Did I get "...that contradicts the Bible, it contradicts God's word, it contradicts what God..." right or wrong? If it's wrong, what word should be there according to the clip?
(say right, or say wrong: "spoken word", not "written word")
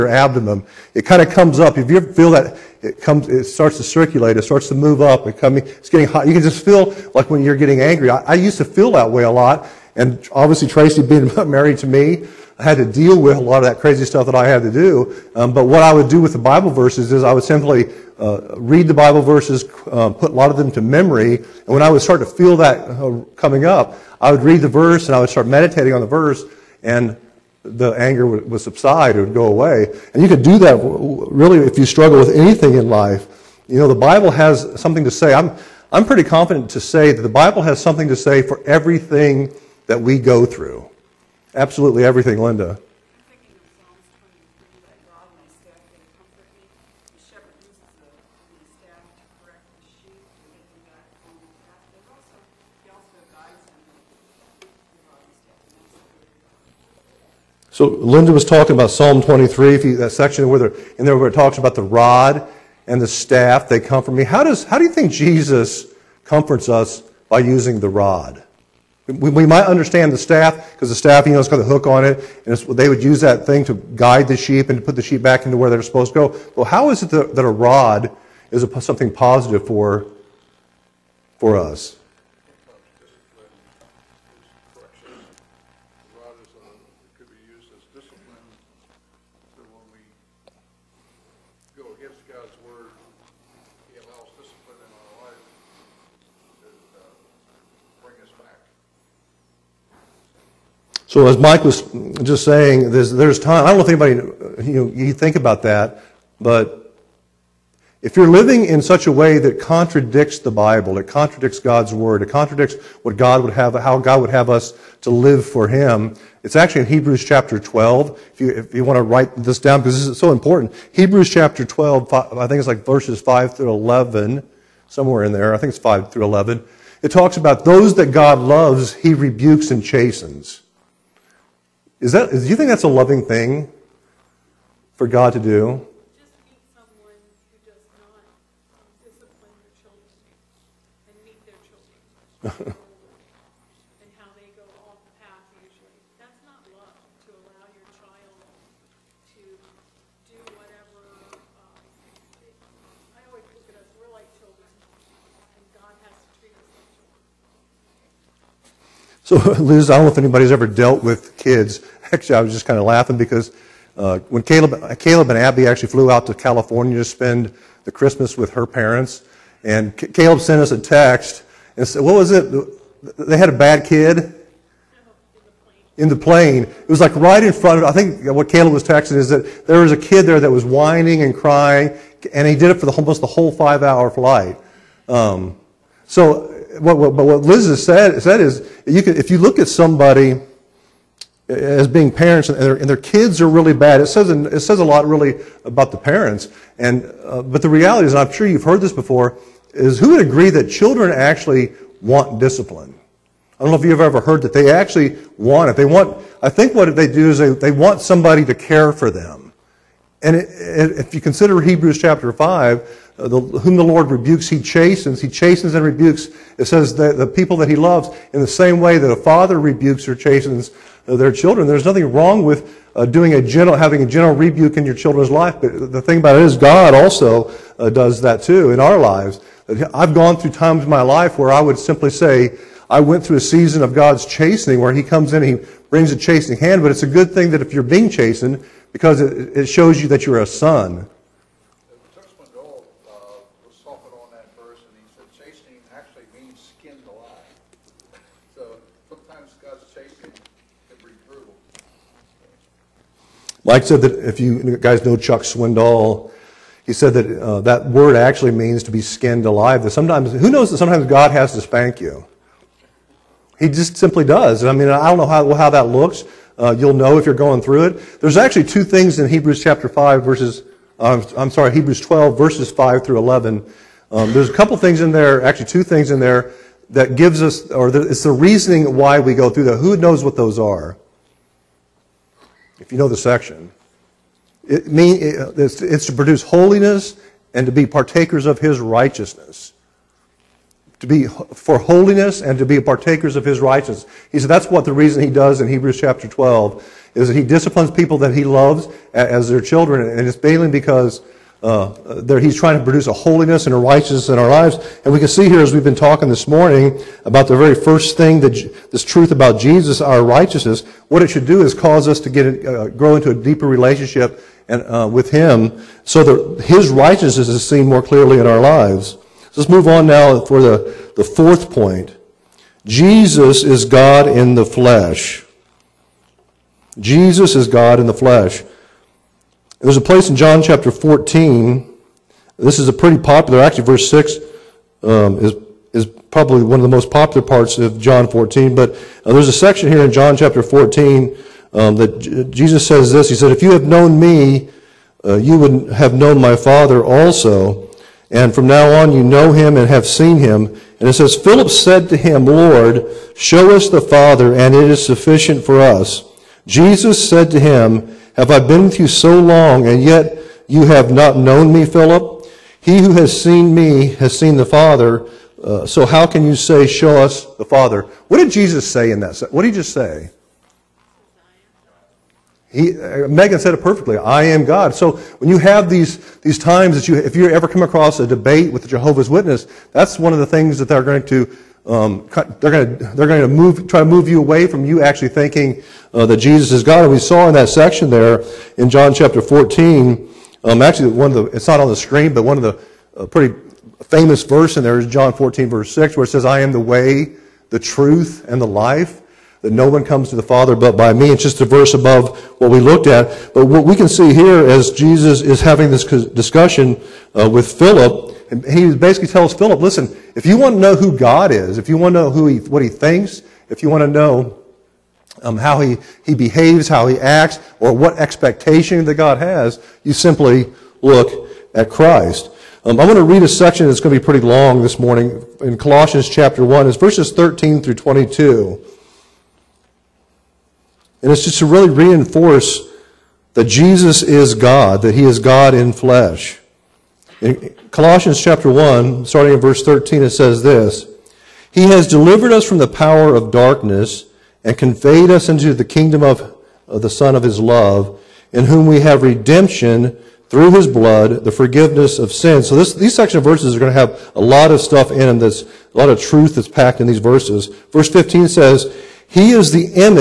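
right.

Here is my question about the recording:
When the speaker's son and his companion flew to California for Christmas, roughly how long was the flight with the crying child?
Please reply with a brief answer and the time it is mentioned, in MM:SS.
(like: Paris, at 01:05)
5 hours, at 03:03.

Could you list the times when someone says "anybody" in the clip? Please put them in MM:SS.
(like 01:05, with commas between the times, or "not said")
01:43, 02:40.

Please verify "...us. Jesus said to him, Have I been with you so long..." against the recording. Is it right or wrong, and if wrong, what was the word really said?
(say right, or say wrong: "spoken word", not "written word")
right.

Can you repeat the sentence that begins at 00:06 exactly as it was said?
You can just feel like when you're getting angry.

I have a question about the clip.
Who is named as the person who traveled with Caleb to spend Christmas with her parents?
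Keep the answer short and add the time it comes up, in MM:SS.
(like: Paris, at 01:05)
Abby, at 02:45.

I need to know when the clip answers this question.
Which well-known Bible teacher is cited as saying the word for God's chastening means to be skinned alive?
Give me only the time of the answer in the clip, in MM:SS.
04:15.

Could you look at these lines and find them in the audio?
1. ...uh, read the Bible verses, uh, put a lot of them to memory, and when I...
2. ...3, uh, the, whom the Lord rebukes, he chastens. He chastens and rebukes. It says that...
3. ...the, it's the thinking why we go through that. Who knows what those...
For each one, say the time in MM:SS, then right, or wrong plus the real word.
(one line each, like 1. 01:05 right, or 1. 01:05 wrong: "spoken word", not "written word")
1. 00:18 right
2. 03:32 wrong: "5", not "3"
3. 04:37 wrong: "reasoning", not "thinking".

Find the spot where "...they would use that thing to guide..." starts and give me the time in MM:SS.
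01:12.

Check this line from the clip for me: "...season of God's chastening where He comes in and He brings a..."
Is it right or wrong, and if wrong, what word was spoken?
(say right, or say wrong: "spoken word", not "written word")
right.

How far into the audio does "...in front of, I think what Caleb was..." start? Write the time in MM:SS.
02:57.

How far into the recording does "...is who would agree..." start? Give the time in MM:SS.
03:19.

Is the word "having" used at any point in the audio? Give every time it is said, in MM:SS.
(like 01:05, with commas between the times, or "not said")
03:43, 06:45.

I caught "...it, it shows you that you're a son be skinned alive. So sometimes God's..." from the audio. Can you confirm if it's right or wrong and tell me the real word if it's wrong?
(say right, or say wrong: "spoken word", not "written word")
right.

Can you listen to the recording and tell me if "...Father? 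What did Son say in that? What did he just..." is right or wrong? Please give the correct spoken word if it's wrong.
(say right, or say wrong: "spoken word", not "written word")
wrong: "Jesus", not "Son".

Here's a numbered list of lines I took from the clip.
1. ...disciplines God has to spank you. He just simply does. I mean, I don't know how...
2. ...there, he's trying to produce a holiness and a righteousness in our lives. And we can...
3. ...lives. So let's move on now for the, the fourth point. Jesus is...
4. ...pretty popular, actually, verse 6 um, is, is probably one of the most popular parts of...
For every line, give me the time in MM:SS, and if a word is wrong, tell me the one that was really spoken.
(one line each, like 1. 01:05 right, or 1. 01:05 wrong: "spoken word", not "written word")
1. 04:20 wrong: "sometimes", not "disciplines"
2. 05:02 right
3. 05:18 right
4. 05:32 right.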